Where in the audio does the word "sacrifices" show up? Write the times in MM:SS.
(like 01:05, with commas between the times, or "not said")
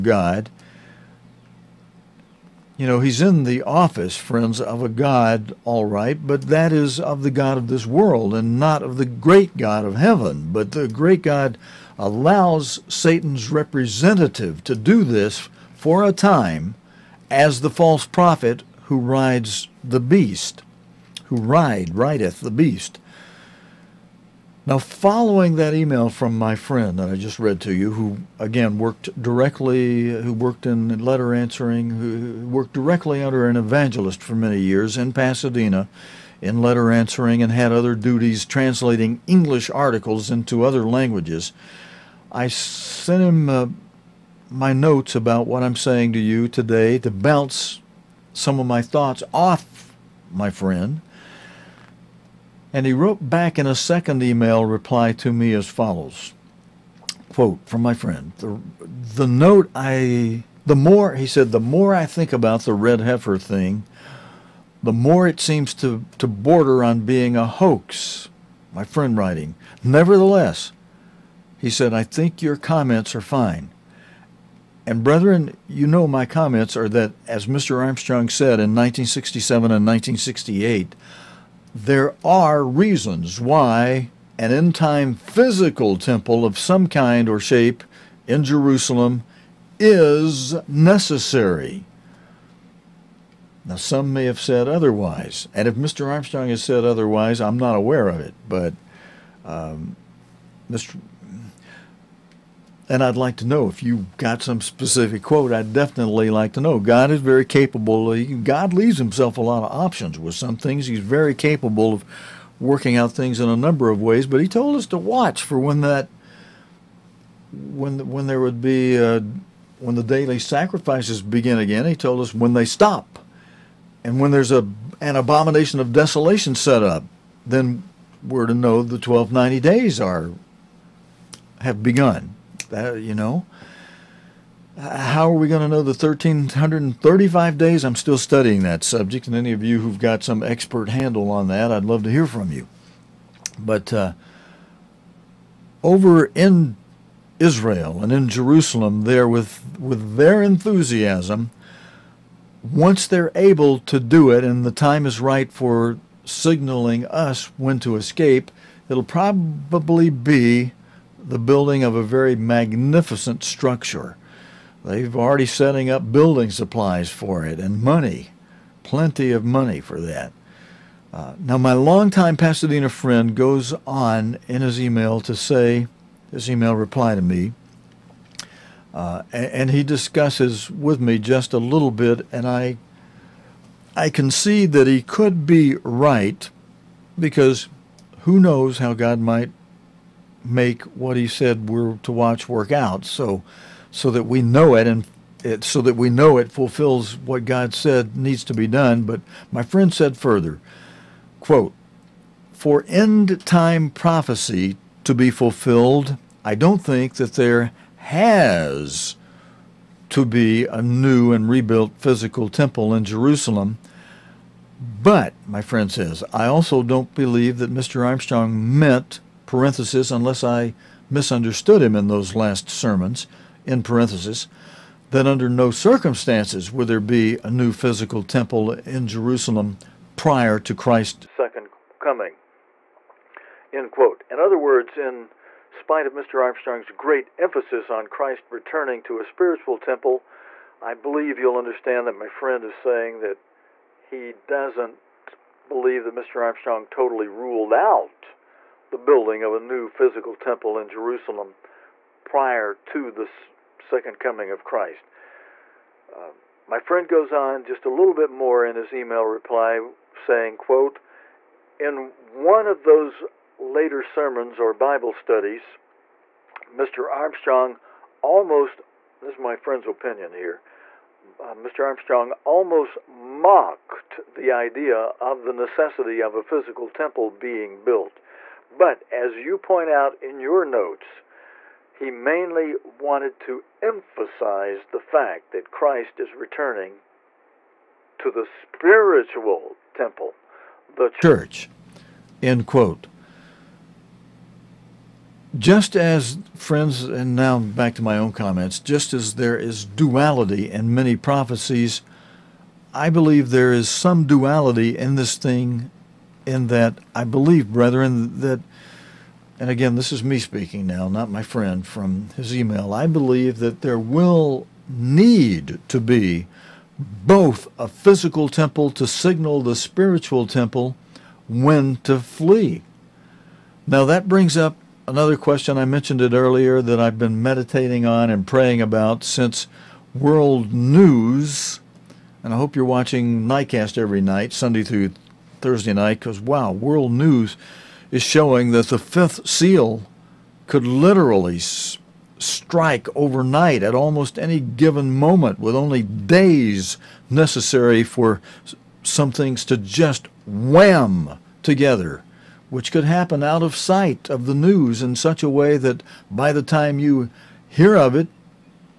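02:00.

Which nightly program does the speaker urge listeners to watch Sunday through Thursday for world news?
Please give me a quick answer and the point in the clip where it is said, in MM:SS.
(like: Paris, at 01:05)
Nightcast, at 05:33.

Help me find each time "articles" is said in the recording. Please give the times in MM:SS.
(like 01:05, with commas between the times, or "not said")
00:39.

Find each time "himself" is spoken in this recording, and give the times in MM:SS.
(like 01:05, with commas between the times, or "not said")
01:48.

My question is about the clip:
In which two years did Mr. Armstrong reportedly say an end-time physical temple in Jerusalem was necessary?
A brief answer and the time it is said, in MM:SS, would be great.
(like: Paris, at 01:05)
1967 and 1968, at 01:18.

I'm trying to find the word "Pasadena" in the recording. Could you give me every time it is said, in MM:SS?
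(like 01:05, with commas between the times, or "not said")
00:35, 02:52.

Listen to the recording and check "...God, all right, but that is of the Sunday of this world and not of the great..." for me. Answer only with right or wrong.
wrong.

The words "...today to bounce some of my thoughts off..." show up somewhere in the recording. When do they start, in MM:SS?
00:46.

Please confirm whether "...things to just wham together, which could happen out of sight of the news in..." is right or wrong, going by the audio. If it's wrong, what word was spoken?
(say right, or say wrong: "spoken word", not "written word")
right.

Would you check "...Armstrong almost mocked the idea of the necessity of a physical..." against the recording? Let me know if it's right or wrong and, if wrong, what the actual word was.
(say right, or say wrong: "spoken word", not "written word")
right.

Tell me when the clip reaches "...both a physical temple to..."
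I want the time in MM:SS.
05:16.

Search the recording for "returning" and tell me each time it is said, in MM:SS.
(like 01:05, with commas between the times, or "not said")
03:58, 04:46.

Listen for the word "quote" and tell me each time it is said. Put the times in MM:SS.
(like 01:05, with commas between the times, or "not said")
00:57, 01:45, 03:21, 03:53, 04:20, 04:52.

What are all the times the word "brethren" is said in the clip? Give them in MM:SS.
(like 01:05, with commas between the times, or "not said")
01:15, 05:07.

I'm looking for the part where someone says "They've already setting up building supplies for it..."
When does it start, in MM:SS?
02:44.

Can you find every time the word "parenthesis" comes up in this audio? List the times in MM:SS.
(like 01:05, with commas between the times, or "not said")
03:39, 03:43.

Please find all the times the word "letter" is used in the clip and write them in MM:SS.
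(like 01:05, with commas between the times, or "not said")
00:31, 00:36.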